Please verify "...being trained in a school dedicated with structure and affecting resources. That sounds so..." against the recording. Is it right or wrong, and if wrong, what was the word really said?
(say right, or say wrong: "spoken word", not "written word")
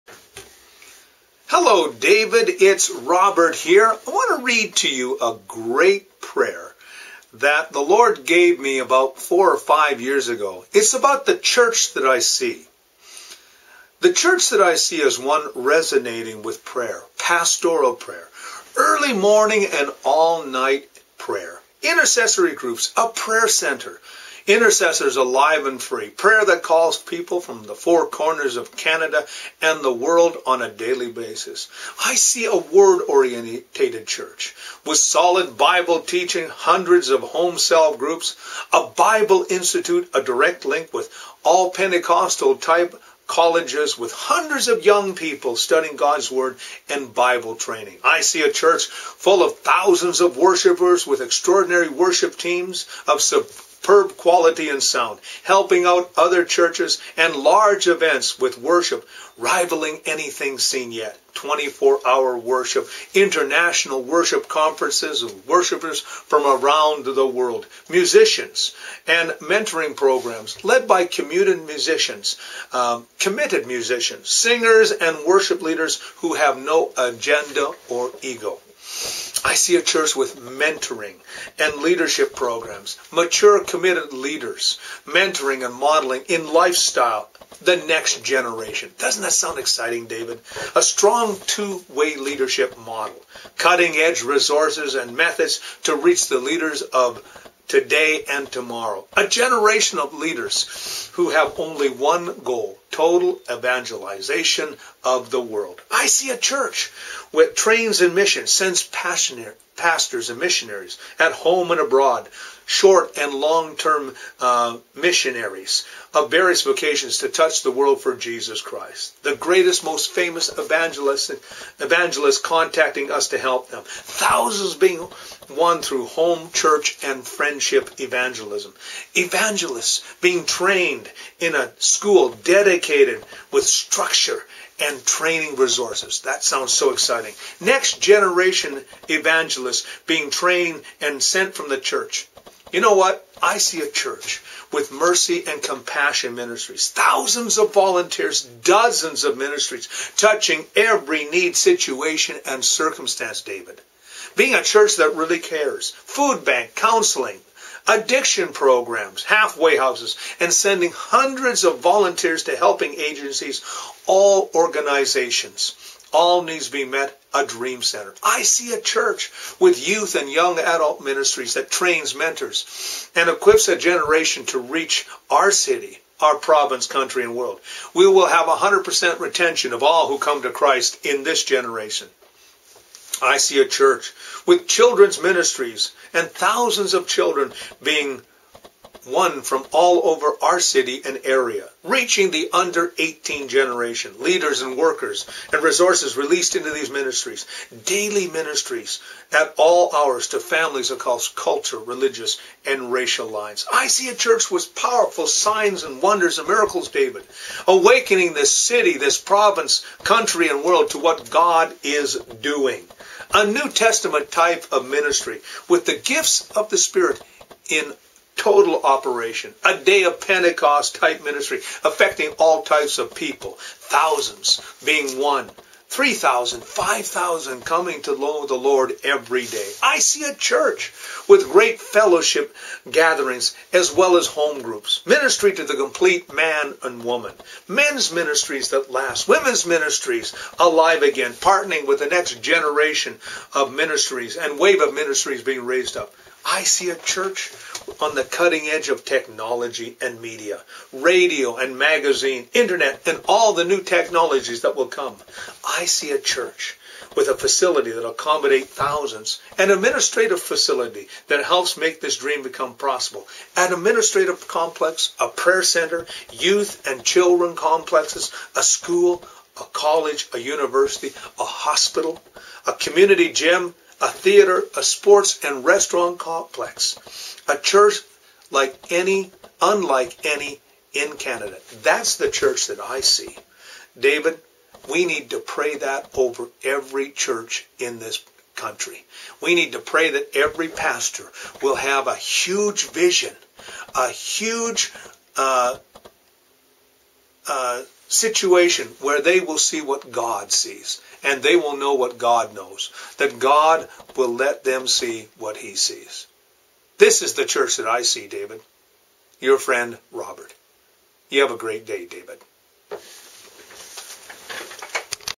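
wrong: "training", not "affecting".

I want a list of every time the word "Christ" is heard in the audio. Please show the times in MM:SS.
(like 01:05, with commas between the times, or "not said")
01:58, 03:00.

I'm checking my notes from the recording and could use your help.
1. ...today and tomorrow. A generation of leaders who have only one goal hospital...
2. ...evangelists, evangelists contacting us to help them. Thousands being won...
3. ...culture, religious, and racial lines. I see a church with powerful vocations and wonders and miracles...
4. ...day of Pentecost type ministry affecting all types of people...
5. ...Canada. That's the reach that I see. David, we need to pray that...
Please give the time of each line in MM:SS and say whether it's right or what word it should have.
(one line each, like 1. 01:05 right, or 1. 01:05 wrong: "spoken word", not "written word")
1. 01:37 wrong: "total", not "hospital"
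2. 02:00 right
3. 03:21 wrong: "signs", not "vocations"
4. 03:39 right
5. 04:41 wrong: "church", not "reach".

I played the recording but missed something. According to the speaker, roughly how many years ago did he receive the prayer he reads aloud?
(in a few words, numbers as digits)
4 or 5 years.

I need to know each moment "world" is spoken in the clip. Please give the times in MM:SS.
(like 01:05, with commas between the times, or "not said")
00:29, 01:07, 01:45, 01:57, 02:57, 03:30.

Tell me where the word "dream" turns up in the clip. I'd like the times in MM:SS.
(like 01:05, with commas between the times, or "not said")
02:47, 04:22.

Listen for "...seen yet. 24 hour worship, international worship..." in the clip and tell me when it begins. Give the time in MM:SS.
01:00.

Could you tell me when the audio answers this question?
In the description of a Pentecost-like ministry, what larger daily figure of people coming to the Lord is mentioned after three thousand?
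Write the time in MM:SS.
03:46.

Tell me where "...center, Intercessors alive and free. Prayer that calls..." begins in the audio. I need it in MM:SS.
00:23.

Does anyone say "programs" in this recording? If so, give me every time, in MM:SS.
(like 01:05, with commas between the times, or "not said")
01:09, 01:22, 02:38.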